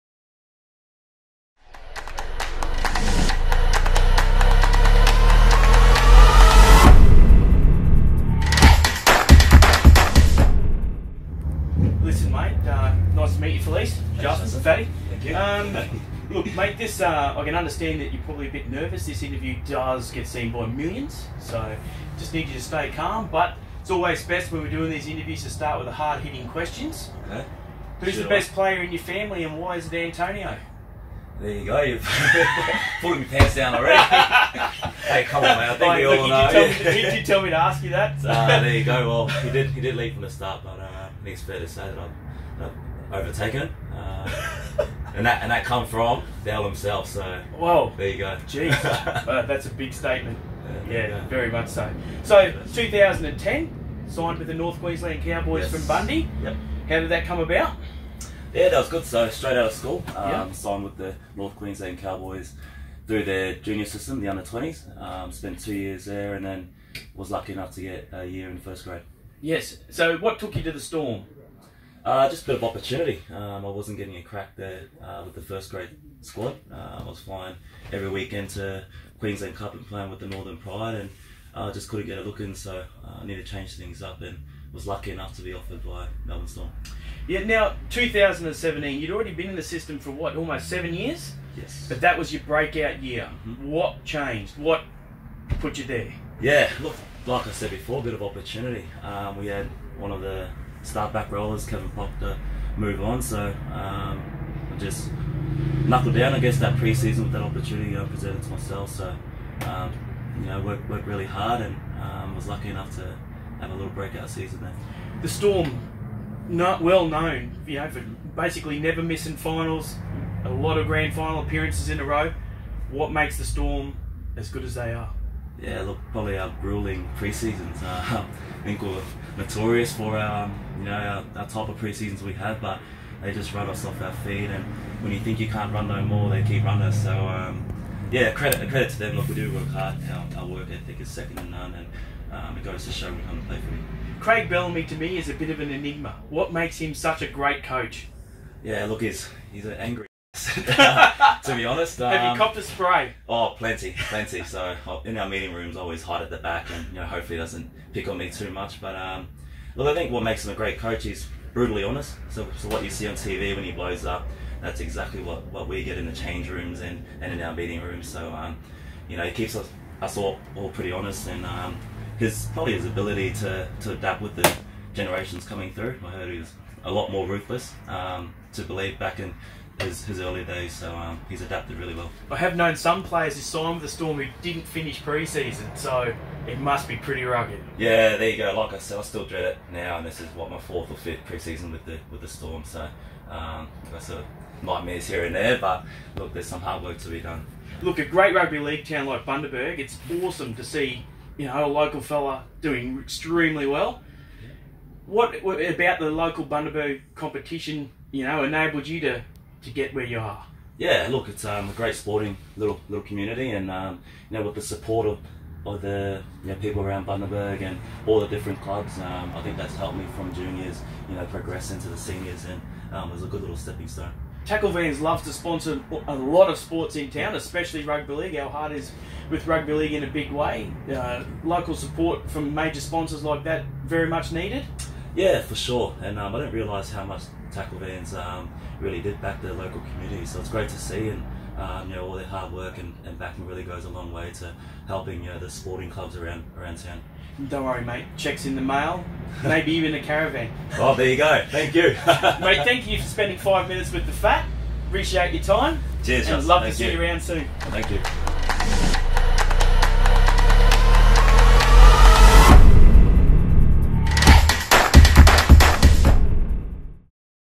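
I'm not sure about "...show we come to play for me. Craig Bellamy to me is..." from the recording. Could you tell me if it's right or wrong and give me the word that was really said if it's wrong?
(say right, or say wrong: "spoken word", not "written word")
right.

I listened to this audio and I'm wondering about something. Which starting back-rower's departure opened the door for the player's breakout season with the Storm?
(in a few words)
Kevin Pop.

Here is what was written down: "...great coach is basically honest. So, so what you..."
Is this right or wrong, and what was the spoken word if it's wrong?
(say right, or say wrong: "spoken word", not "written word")
wrong: "brutally", not "basically".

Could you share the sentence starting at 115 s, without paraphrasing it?
The Storm, not well known, you know, for basically never missing finals, a lot of grand final appearances in a row.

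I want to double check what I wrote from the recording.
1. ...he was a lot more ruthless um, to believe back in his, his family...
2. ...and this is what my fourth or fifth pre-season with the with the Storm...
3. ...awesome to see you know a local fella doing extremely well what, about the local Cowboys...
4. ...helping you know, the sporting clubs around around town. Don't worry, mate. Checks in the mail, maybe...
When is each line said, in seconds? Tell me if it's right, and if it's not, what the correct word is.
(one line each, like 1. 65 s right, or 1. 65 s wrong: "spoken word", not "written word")
1. 176 s wrong: "early", not "family"
2. 189 s right
3. 200 s wrong: "Bundaberg", not "Cowboys"
4. 244 s right.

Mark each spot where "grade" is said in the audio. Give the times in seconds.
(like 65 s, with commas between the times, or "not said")
68 s, 75 s.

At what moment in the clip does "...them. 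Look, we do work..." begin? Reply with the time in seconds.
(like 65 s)
138 s.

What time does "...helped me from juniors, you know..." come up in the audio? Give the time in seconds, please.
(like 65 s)
219 s.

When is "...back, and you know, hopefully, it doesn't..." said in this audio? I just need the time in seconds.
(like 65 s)
156 s.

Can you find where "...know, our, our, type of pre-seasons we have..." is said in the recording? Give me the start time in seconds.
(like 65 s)
130 s.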